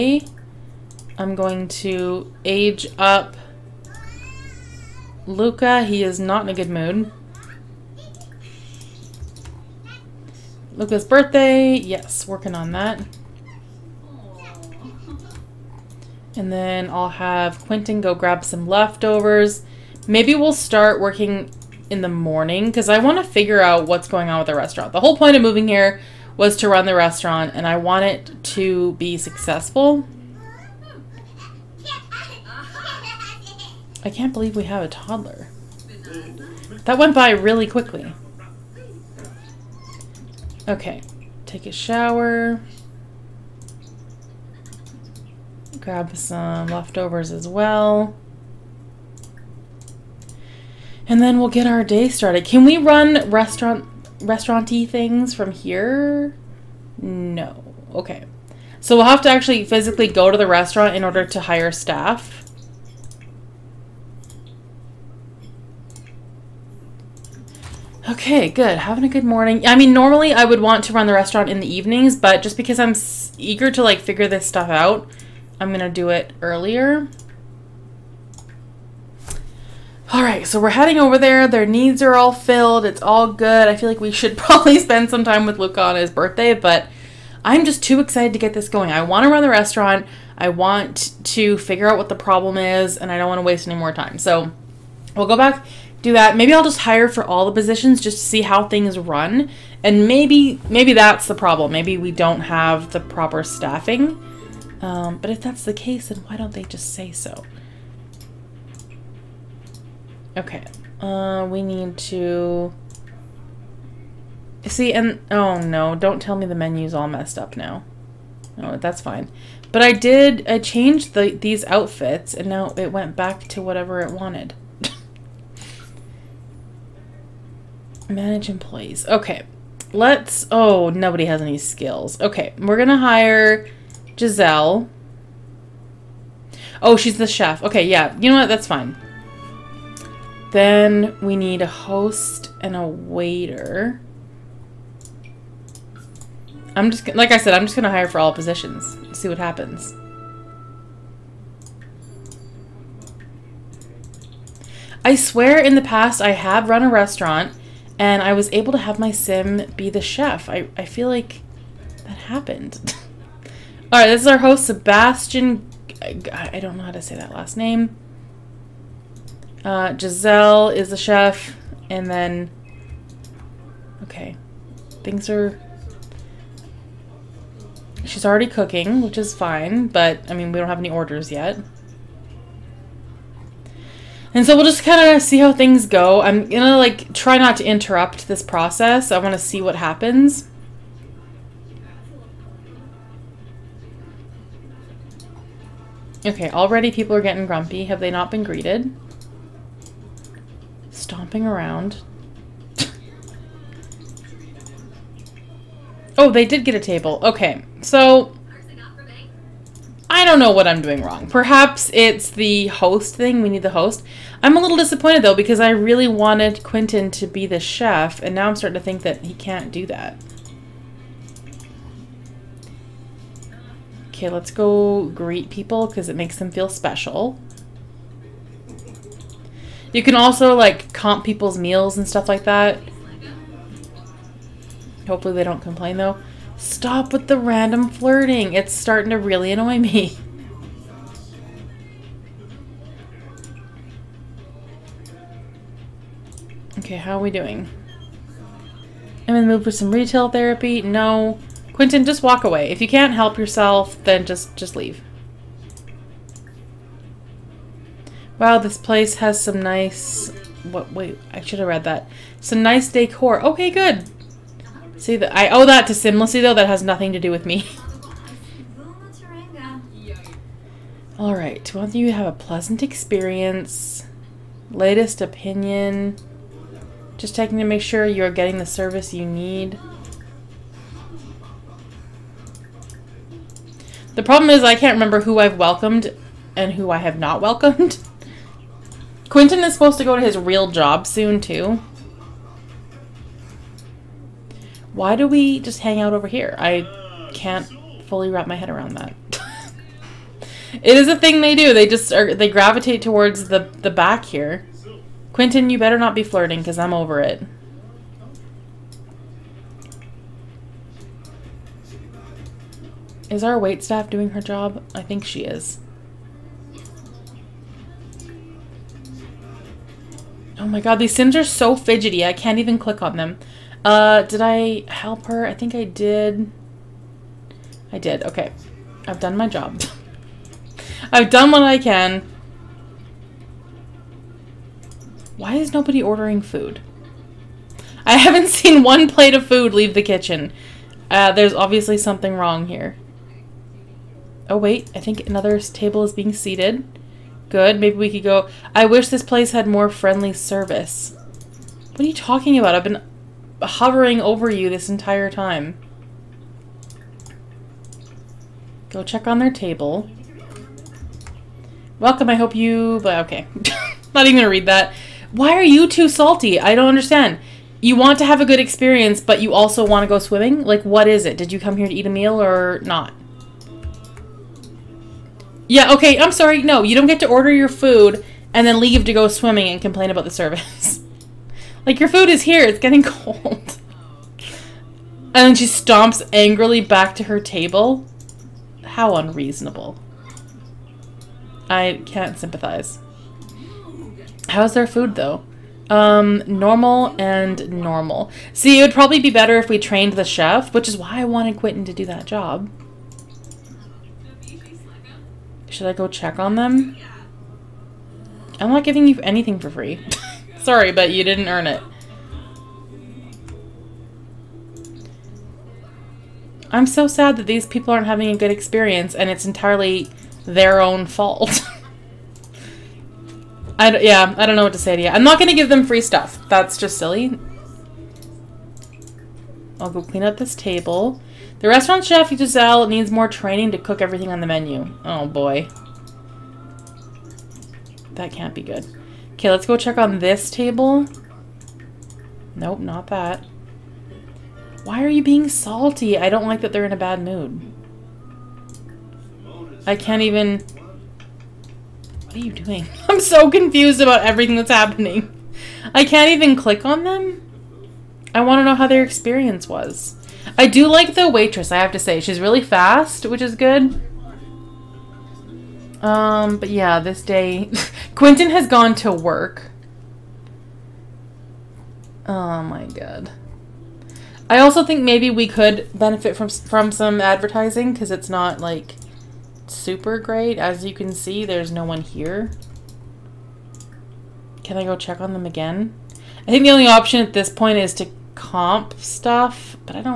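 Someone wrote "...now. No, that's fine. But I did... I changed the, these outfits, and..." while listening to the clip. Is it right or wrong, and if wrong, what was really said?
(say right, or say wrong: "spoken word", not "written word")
right.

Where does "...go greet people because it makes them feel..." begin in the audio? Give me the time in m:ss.
3:44.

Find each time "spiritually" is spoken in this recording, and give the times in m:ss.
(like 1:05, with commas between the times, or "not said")
not said.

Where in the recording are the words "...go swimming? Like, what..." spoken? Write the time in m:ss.
6:10.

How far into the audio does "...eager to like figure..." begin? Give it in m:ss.
1:13.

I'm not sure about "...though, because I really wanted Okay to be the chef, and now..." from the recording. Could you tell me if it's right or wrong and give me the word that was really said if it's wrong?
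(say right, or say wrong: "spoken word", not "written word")
wrong: "Quentin", not "Okay".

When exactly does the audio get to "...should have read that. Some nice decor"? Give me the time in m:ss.
4:21.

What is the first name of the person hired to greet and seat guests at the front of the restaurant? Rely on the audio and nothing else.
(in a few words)
Sebastian.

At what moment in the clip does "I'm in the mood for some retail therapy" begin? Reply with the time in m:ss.
4:09.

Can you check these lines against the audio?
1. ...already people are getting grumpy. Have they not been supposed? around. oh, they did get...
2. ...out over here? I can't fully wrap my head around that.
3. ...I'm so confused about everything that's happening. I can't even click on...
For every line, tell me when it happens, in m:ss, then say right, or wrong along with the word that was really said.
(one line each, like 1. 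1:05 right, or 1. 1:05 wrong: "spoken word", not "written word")
1. 3:16 wrong: "greeted", not "supposed"
2. 4:55 right
3. 7:33 right.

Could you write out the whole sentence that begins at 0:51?
And then we'll get our day started.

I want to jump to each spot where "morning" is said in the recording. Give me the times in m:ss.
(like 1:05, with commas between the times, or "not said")
0:22, 1:09.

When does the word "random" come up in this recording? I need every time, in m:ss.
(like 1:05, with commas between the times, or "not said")
3:57.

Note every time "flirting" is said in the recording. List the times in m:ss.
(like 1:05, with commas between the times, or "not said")
3:57, 5:06.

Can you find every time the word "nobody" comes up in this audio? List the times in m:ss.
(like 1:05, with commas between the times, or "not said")
2:10, 5:35.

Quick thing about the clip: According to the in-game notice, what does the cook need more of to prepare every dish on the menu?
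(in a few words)
Training.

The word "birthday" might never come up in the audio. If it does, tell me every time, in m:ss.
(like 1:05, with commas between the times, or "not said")
0:11, 1:26.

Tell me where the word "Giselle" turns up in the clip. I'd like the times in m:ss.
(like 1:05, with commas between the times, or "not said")
2:14, 2:49, 7:12.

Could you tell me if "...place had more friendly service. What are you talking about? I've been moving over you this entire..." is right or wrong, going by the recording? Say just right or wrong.
wrong.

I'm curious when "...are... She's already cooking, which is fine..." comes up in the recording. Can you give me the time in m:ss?
2:55.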